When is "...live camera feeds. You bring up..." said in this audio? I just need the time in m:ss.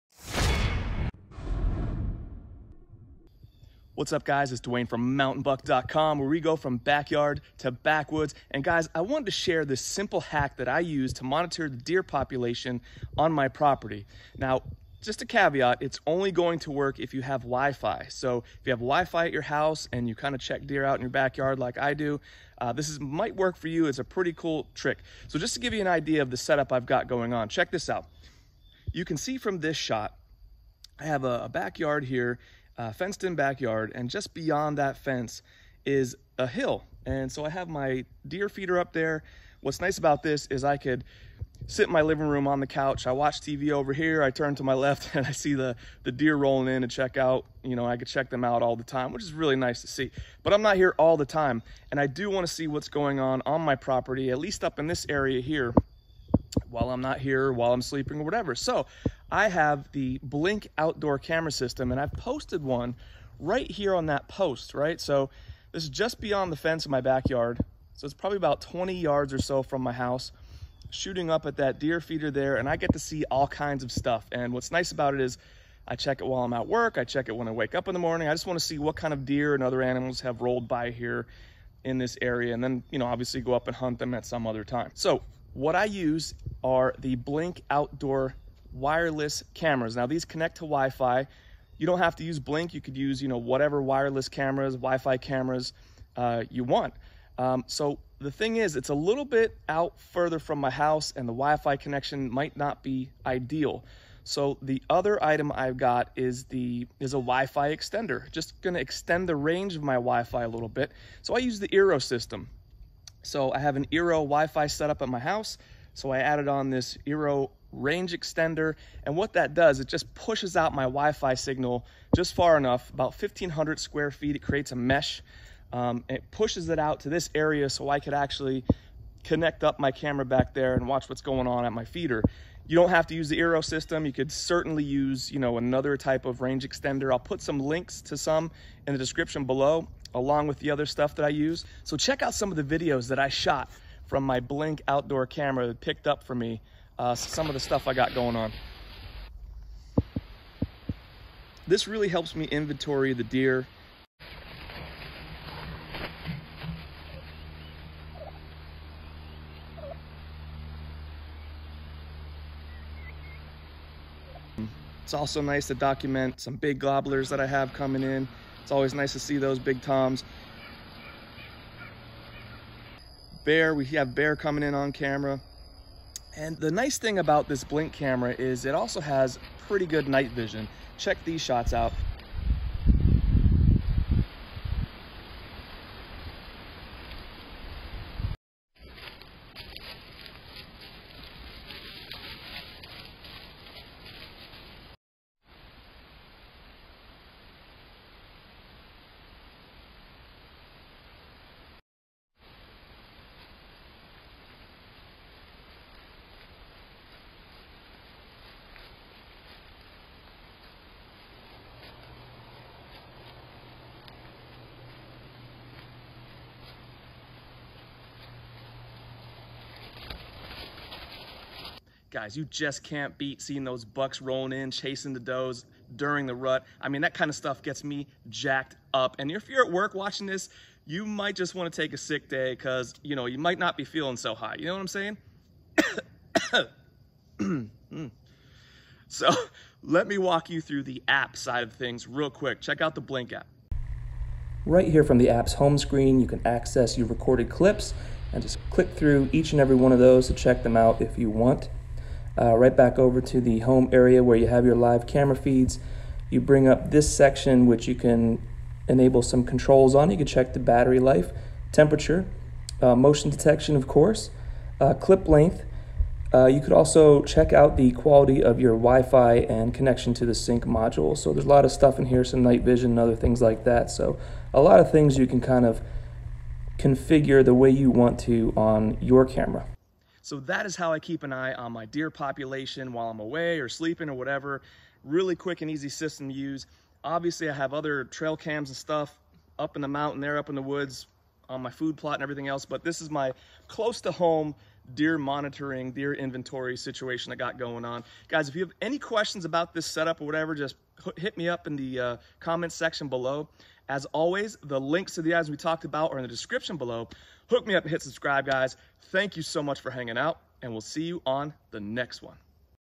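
4:14.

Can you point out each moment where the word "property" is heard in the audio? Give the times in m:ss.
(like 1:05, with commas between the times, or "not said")
0:13, 0:53.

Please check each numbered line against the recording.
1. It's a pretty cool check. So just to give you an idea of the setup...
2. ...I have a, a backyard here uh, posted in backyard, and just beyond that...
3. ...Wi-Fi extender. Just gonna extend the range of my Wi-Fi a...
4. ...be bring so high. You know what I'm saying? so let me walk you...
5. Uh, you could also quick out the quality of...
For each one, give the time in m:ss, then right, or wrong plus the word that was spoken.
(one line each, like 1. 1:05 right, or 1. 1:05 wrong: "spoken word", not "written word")
1. 0:23 wrong: "trick", not "check"
2. 0:30 wrong: "fenced", not "posted"
3. 1:47 right
4. 3:53 wrong: "feeling", not "bring"
5. 4:26 wrong: "check", not "quick".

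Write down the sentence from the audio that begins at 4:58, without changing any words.
Guys, if you have any questions about this setup or whatever, just hit me up in the uh, comments section below.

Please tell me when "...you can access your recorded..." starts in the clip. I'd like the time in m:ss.
4:06.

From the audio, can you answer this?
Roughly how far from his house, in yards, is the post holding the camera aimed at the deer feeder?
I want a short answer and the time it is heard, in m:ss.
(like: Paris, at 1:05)
20 yards, at 1:08.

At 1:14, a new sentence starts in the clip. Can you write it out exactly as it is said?
And what's nice about it is I check it while I'm at work.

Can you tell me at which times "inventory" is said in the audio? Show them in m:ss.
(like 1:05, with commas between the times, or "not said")
2:32, 4:56.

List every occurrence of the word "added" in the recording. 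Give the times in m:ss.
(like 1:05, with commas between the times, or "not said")
1:56.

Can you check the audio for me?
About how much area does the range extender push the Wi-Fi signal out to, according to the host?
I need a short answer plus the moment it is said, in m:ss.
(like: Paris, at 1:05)
1500 square feet, at 2:03.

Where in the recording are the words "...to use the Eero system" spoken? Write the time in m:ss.
2:13.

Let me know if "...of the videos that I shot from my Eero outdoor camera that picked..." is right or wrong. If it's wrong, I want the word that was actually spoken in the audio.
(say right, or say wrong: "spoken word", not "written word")
wrong: "Blink", not "Eero".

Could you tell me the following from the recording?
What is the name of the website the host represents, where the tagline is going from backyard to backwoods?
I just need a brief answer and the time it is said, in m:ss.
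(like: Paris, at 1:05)
mountainbuck.com, at 0:05.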